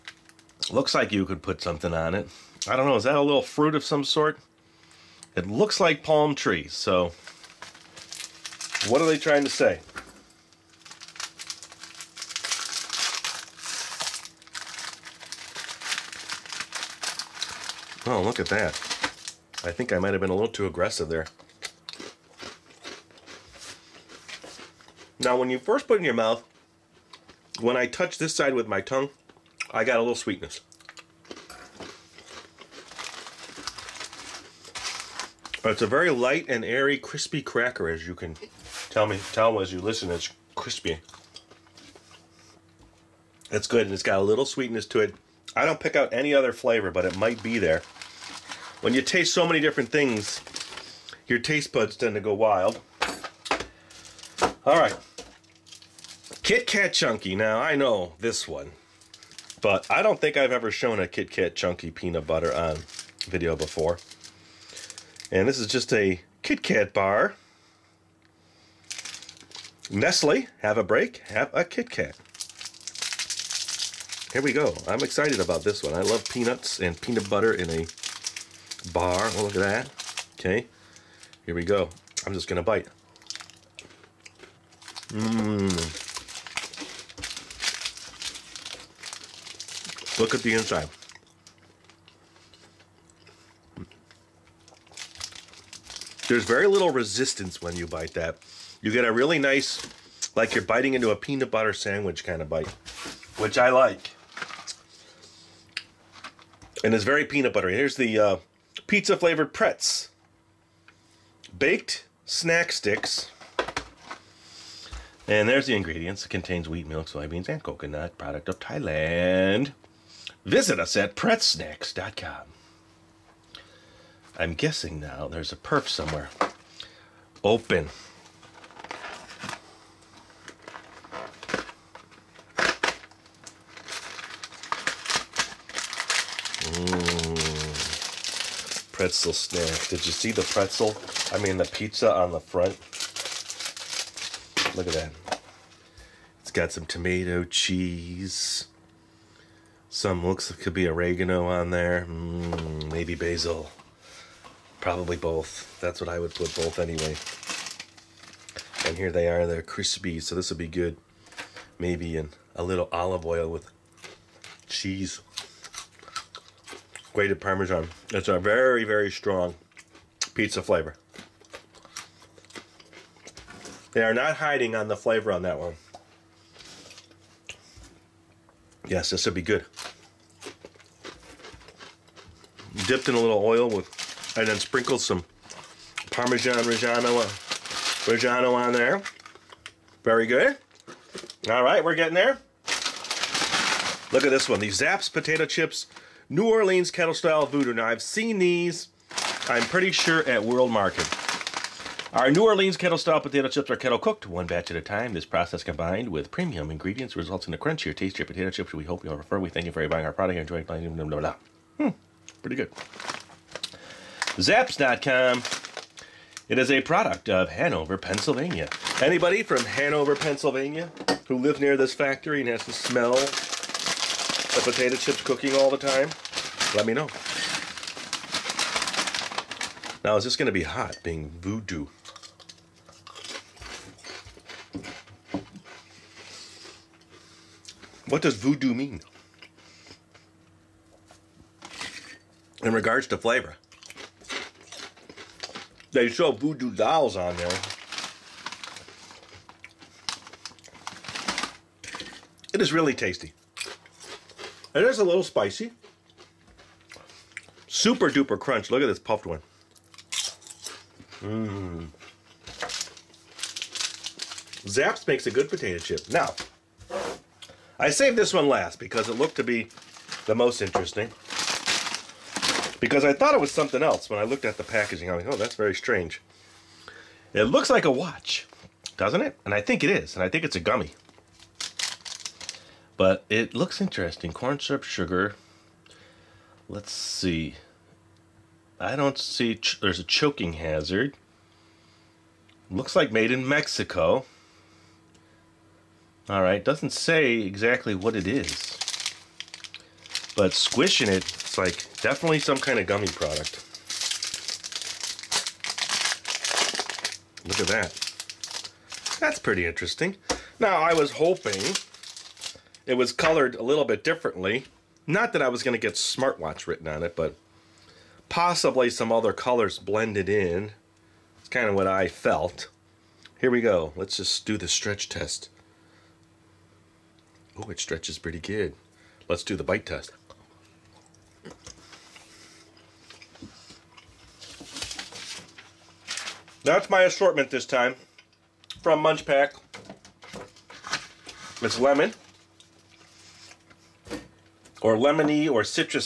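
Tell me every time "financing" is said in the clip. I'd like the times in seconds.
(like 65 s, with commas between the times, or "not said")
not said.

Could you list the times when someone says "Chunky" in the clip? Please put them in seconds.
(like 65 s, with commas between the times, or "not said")
56 s, 61 s.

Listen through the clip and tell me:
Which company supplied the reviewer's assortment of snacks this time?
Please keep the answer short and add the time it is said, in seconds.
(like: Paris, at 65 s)
MunchPak, at 339 s.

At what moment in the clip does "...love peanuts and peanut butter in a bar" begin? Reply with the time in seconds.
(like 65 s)
76 s.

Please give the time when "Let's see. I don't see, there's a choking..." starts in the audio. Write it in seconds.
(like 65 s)
286 s.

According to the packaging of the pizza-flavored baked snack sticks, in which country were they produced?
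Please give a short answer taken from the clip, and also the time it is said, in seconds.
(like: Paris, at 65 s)
Thailand, at 118 s.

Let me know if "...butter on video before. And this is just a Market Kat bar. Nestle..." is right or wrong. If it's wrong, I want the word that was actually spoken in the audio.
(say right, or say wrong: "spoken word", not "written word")
wrong: "Kit", not "Market".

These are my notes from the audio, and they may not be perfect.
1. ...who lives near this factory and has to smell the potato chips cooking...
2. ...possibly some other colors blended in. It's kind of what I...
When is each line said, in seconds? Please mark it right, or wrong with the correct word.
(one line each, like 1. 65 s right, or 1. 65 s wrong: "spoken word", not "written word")
1. 221 s right
2. 318 s right.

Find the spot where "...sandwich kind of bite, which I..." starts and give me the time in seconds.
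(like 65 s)
101 s.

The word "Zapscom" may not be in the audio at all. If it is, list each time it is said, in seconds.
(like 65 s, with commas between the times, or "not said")
214 s.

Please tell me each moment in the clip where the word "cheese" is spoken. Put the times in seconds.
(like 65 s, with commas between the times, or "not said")
147 s, 164 s.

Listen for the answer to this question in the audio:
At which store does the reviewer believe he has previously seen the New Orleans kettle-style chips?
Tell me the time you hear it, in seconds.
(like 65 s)
200 s.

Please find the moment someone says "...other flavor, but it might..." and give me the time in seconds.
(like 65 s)
46 s.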